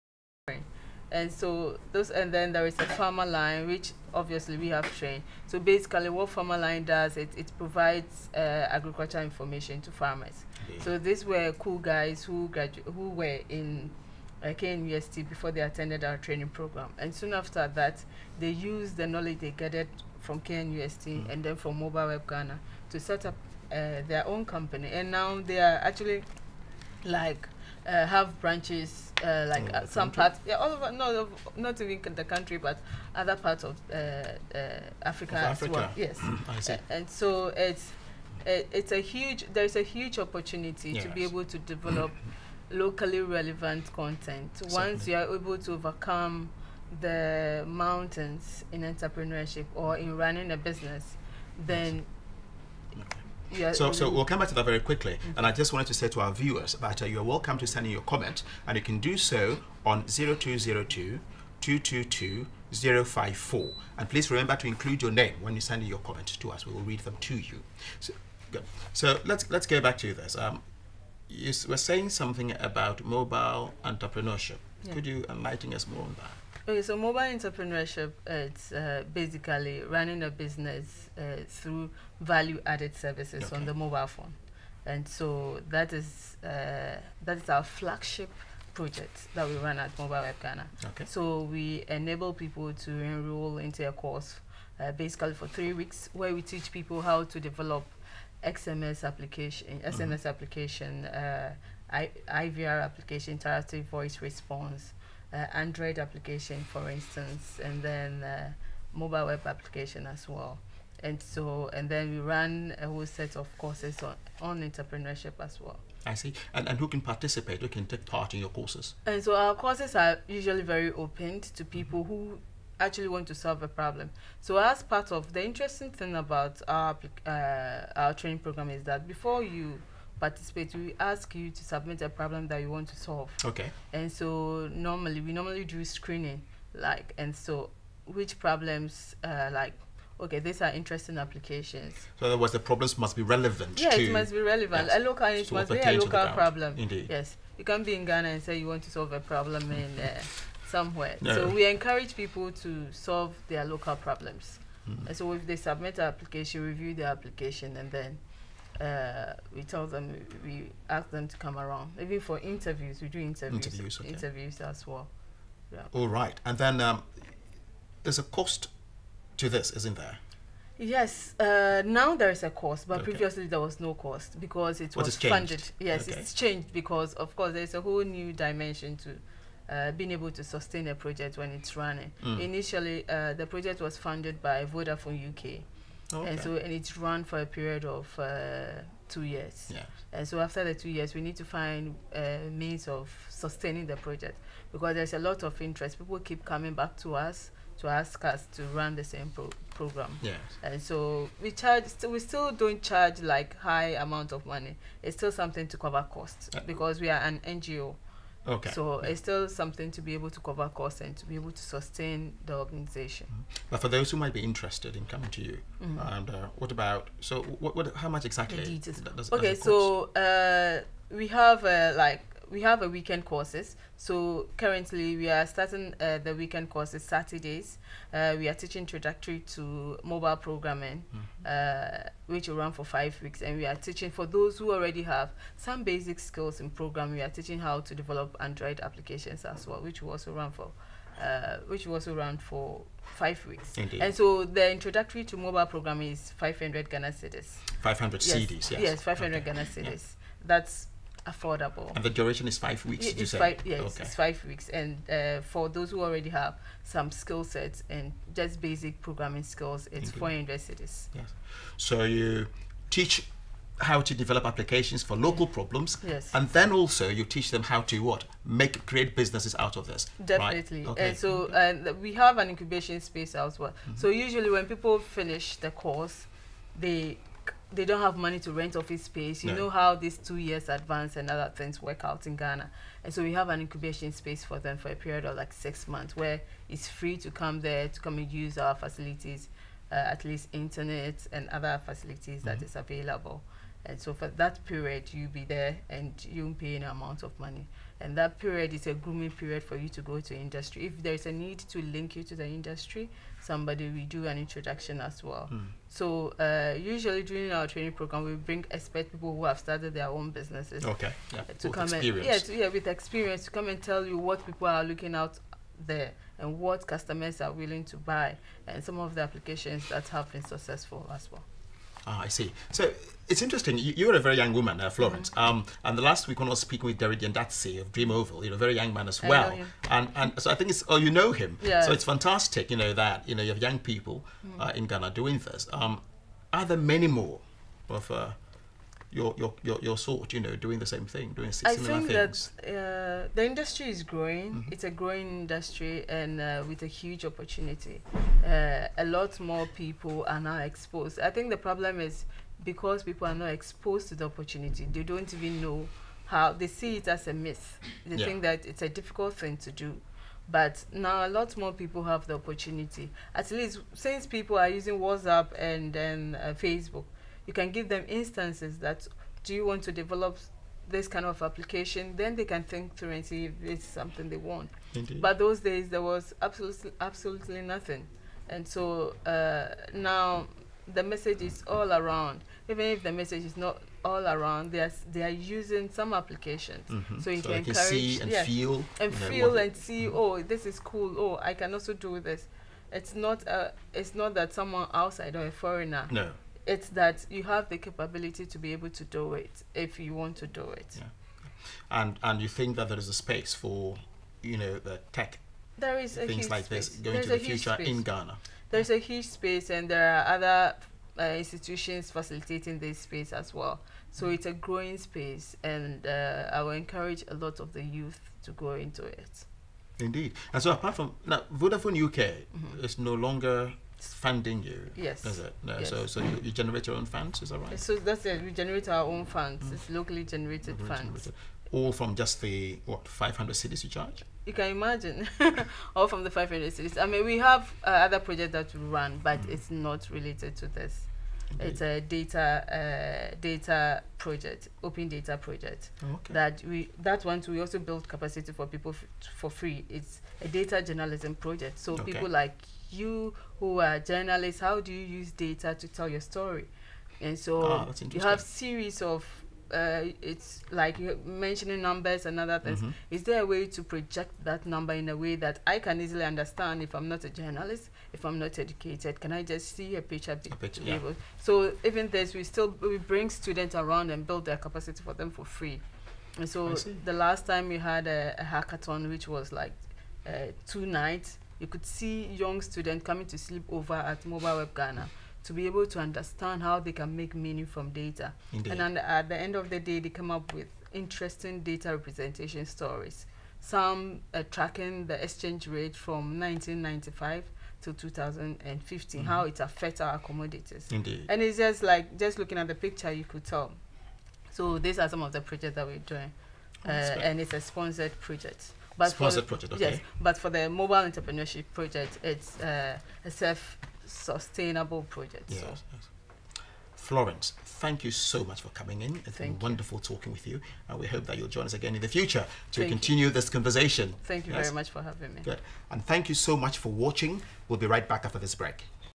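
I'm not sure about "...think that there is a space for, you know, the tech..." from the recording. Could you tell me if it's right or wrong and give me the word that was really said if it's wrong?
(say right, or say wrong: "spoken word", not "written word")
right.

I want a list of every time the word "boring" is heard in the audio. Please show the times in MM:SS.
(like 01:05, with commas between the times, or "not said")
not said.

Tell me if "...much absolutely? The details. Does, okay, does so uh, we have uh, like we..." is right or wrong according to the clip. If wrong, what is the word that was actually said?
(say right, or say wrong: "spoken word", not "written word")
wrong: "exactly", not "absolutely".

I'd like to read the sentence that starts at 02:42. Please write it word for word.
Even for interviews, we do interviews, interviews, okay.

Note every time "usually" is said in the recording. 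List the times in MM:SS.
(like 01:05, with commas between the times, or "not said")
02:00, 04:34, 05:06.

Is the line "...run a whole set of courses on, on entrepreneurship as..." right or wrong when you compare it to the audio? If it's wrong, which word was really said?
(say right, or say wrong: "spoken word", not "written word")
right.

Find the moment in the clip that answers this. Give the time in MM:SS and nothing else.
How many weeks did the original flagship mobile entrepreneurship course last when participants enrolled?
01:35.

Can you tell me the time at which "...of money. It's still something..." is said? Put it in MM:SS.
03:24.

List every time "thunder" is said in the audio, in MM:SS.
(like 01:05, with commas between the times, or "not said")
not said.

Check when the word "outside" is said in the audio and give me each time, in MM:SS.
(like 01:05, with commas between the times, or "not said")
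06:34.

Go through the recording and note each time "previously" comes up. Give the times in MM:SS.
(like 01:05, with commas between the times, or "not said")
02:53.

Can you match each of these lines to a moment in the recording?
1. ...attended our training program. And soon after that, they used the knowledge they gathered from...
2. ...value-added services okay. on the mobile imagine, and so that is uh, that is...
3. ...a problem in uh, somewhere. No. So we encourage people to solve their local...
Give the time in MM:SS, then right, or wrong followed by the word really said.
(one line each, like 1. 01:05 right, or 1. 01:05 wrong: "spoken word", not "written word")
1. 00:15 right
2. 01:22 wrong: "phone", not "imagine"
3. 02:29 right.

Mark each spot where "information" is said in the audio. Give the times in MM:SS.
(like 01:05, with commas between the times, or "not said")
00:09.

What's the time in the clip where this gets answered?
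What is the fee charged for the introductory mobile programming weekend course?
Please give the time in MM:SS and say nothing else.
04:06.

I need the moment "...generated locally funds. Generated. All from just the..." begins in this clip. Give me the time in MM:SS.
07:10.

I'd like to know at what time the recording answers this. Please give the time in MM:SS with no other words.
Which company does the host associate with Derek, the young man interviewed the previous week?
05:27.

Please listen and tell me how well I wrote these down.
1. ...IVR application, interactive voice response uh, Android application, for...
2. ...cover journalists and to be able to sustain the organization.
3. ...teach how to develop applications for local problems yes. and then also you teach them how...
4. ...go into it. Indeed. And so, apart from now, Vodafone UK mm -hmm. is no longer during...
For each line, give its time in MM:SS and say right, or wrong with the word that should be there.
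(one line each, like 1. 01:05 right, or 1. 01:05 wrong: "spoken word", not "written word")
1. 01:42 right
2. 03:30 wrong: "costs", not "journalists"
3. 04:22 right
4. 06:58 wrong: "funding", not "during".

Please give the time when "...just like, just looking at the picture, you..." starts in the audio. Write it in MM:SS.
08:21.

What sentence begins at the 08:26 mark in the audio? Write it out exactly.
Uh, and it's a sponsored project.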